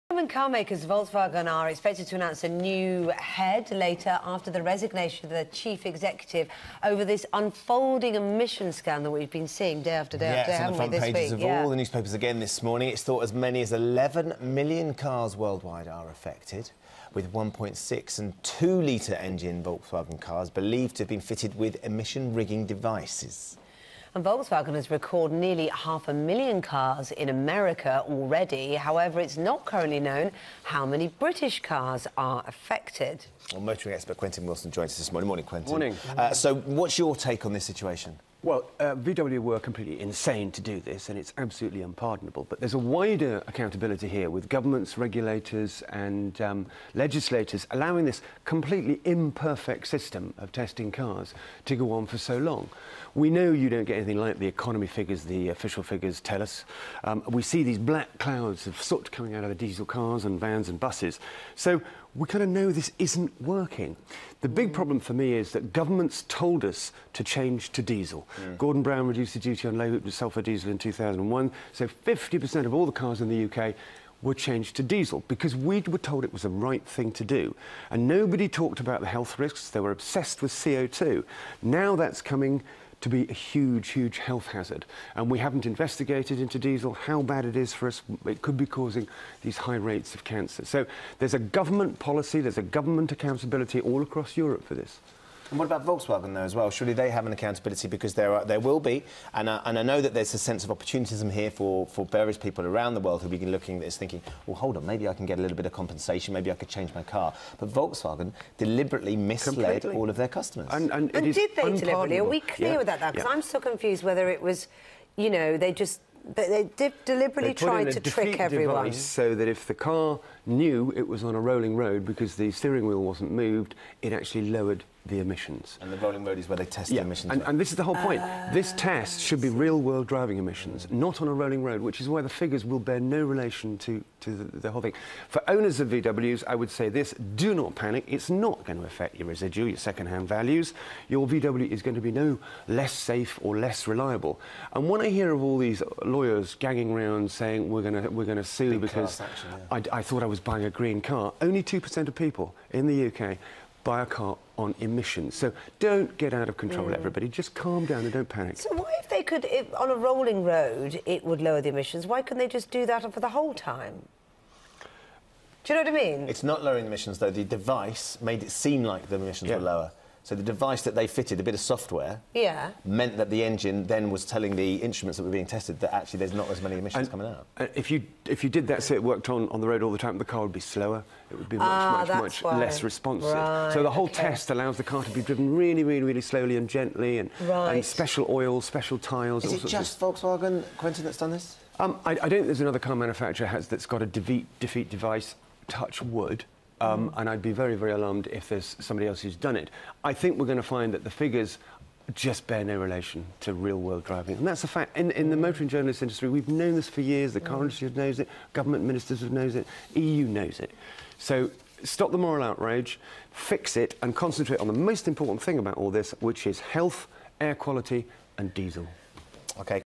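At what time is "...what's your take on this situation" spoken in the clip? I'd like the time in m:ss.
0:36.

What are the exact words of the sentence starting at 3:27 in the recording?
The car industry knows it, government ministers have knows it, EU knows it.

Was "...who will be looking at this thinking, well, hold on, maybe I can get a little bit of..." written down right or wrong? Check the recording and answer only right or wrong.
right.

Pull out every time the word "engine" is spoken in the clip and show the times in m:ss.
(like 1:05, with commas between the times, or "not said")
0:19, 2:53.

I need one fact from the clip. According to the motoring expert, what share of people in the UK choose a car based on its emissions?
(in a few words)
2%.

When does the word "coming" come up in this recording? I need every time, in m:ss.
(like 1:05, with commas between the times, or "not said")
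0:59, 1:22, 2:57.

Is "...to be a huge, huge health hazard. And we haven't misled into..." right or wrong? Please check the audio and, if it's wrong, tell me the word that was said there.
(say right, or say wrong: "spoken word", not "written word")
wrong: "investigated", not "misled".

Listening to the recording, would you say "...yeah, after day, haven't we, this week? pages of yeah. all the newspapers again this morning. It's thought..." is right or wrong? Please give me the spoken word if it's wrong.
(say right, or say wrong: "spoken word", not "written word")
right.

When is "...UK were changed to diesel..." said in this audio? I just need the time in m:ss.
1:13.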